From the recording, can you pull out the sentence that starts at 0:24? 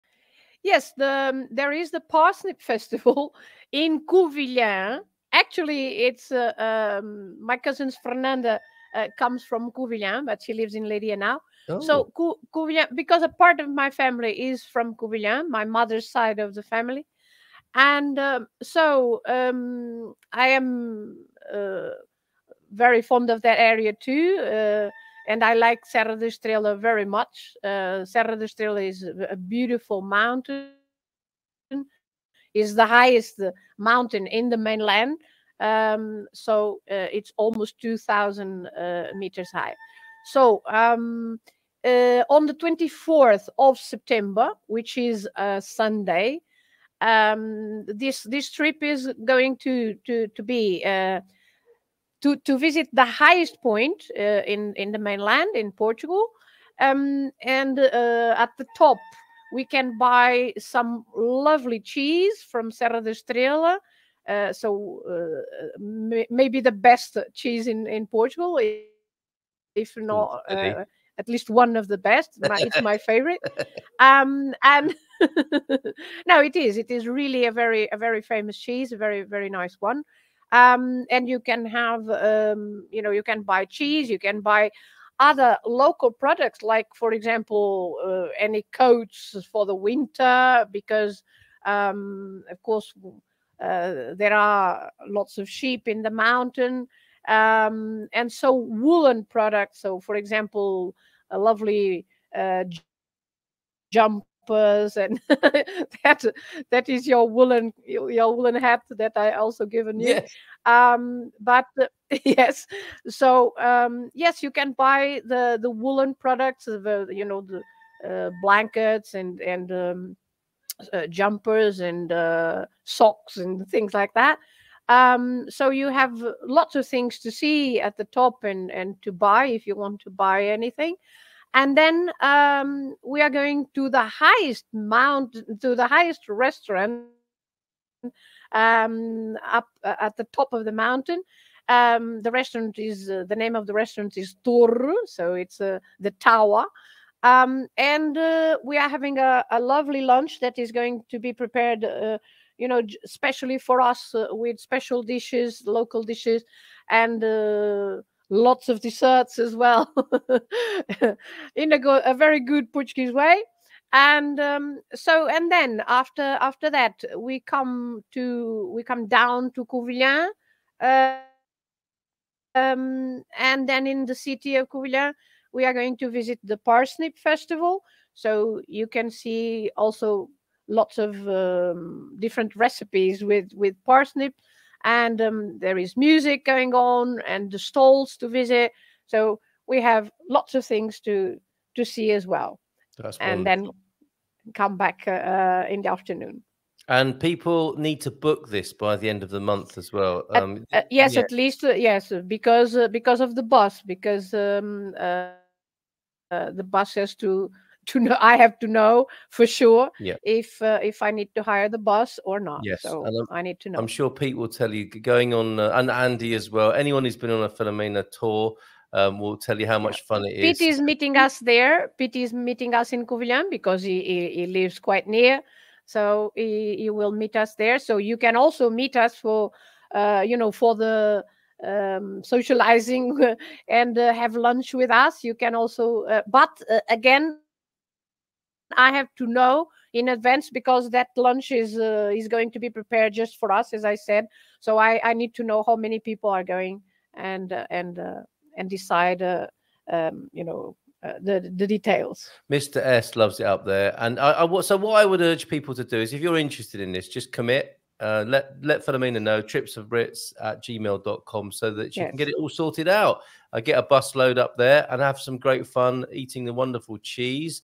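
Uh, and I like Serra da Estrela very much.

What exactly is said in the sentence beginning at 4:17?
Uh, let let Filomena know trips of Brits at gmail.com so that she yes.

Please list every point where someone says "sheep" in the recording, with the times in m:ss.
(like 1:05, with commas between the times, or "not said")
1:35.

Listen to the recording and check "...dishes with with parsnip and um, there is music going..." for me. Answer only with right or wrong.
wrong.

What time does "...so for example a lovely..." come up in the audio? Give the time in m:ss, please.
1:39.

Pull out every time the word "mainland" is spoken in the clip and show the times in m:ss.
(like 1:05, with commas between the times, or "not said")
0:34, 0:54.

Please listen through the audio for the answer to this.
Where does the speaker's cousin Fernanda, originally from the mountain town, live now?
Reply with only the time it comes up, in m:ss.
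0:10.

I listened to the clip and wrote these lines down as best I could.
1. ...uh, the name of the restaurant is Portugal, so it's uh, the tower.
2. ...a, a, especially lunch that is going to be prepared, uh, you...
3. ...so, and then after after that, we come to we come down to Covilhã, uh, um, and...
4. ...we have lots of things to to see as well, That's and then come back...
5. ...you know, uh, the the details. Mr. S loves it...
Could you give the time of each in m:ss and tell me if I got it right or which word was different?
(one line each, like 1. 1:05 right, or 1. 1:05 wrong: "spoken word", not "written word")
1. 2:23 wrong: "Torre", not "Portugal"
2. 2:29 wrong: "lovely", not "especially"
3. 2:44 right
4. 3:09 right
5. 4:10 right.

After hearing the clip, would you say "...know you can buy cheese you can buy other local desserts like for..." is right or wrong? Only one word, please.
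wrong.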